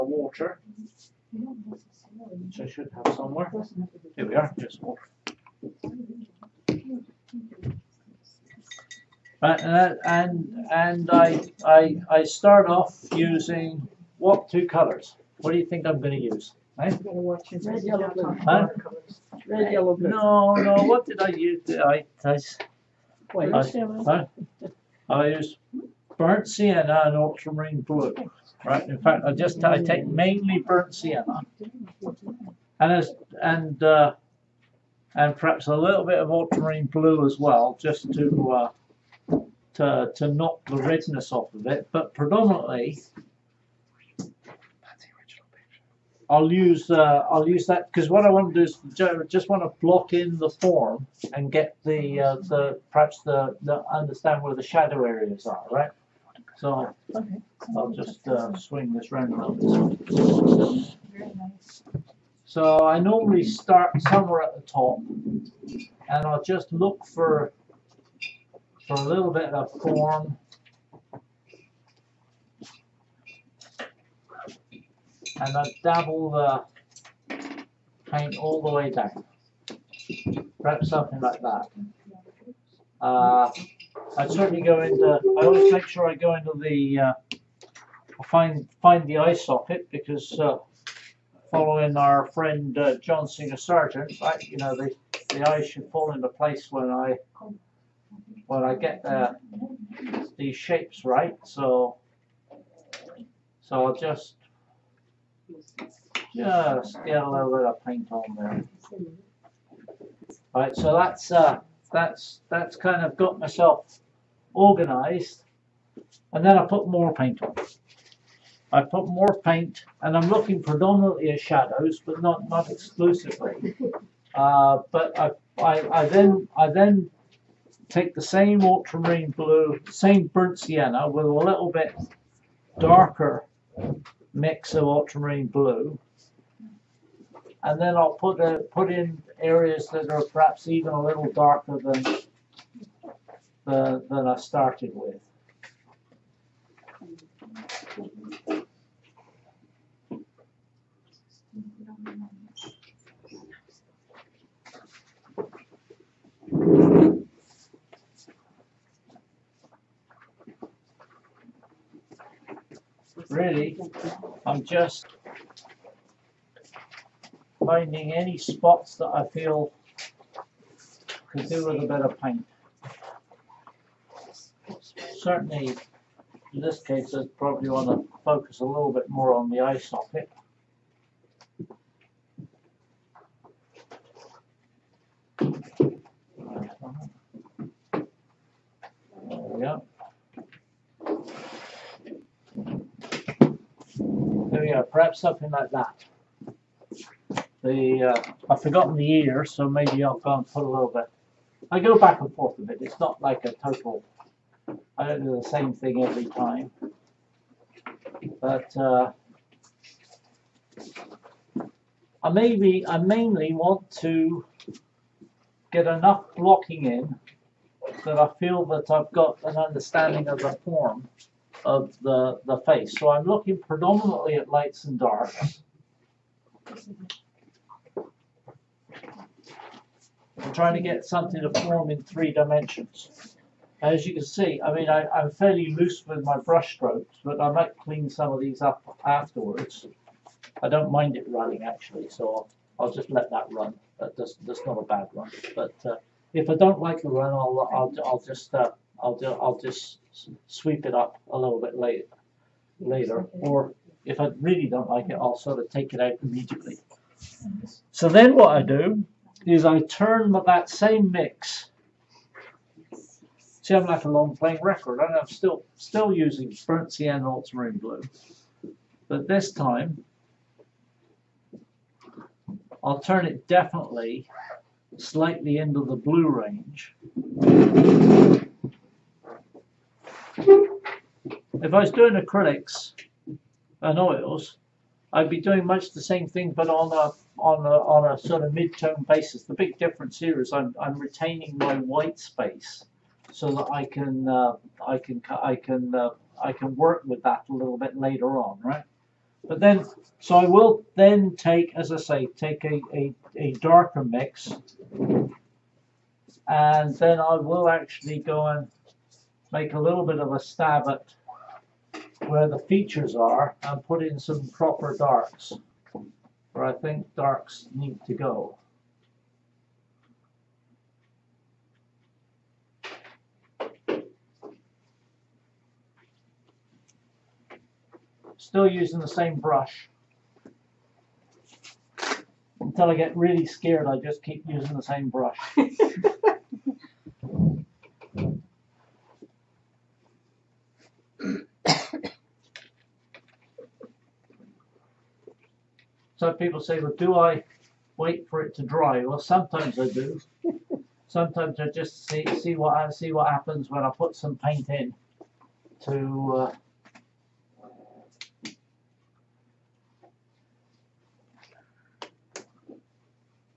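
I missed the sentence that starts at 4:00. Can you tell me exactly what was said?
I don't mind it running, actually, so I'll, just let that run.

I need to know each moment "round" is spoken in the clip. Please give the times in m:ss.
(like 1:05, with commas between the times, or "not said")
0:59.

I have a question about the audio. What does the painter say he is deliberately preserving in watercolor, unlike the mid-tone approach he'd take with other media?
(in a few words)
white space.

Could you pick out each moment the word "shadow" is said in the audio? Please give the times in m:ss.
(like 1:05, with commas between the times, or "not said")
0:54, 2:01.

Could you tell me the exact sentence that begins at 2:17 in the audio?
And then I'll put a, put in areas that are perhaps even a little darker than the, than I started with.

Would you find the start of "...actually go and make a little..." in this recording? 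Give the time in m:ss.
5:07.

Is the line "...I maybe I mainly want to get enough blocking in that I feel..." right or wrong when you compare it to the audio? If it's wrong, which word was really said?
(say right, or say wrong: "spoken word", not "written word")
right.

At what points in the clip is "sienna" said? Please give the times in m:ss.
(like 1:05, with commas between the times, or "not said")
0:26, 0:30, 2:10.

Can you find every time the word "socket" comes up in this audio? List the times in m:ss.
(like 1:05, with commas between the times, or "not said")
1:29, 2:59.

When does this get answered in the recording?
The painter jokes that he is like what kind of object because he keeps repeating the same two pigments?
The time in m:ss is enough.
4:24.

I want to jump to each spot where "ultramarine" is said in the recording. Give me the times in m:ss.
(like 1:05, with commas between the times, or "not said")
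0:27, 0:36, 2:08, 2:14, 4:27.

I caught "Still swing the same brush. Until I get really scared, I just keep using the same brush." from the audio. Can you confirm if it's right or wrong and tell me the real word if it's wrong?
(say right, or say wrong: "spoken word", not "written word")
wrong: "using", not "swing".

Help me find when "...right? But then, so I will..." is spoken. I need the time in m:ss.
4:58.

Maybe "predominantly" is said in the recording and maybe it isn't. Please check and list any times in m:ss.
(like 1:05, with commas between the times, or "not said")
0:42, 2:00, 3:43.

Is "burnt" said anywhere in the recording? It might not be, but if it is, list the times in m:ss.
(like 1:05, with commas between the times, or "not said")
0:26, 0:30, 2:10, 4:26.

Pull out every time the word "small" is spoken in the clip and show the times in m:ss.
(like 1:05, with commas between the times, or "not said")
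not said.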